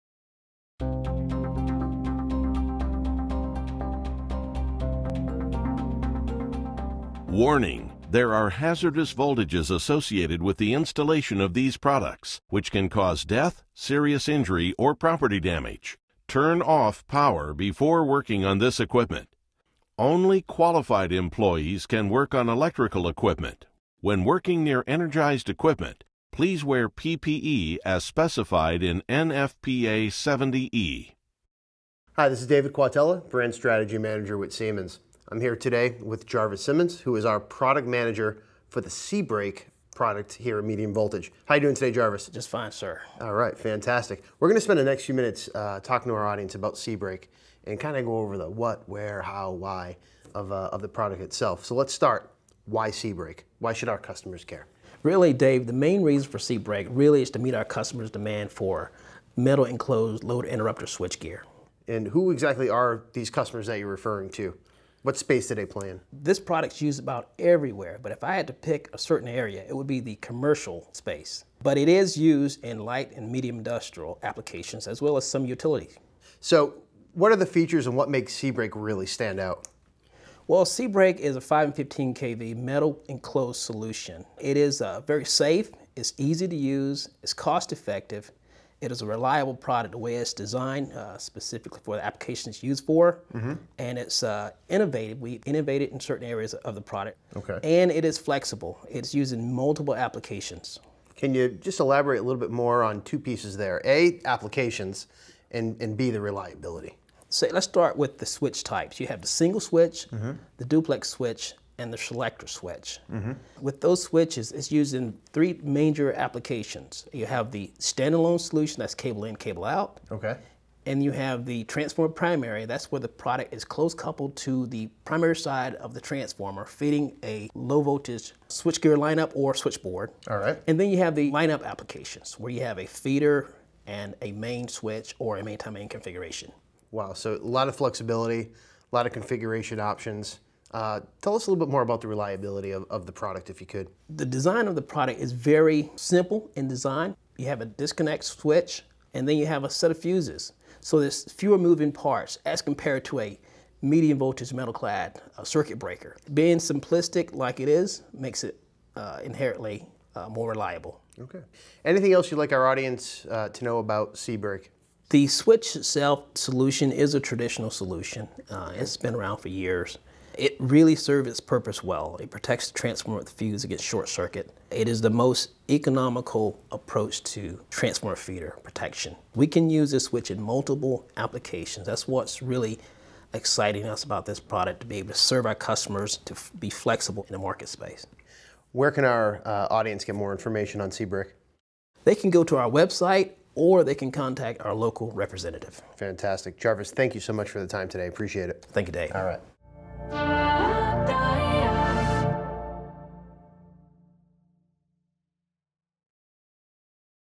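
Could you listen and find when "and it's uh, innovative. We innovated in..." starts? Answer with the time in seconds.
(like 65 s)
93 s.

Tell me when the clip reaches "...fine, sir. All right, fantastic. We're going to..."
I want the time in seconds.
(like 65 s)
42 s.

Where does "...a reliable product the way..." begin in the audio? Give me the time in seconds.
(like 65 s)
89 s.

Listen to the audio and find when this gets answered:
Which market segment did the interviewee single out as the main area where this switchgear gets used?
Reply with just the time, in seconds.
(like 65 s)
70 s.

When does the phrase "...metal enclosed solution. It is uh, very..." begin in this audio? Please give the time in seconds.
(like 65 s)
82 s.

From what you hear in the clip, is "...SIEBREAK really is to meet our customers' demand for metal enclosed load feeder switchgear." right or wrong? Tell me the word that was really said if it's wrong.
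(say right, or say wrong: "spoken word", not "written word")
wrong: "interrupter", not "feeder".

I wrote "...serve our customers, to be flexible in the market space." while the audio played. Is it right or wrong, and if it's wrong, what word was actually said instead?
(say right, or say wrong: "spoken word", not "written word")
right.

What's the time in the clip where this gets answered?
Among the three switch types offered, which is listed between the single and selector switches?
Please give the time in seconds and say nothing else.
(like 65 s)
110 s.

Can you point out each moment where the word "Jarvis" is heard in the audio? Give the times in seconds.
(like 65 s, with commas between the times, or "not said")
36 s, 41 s, 196 s.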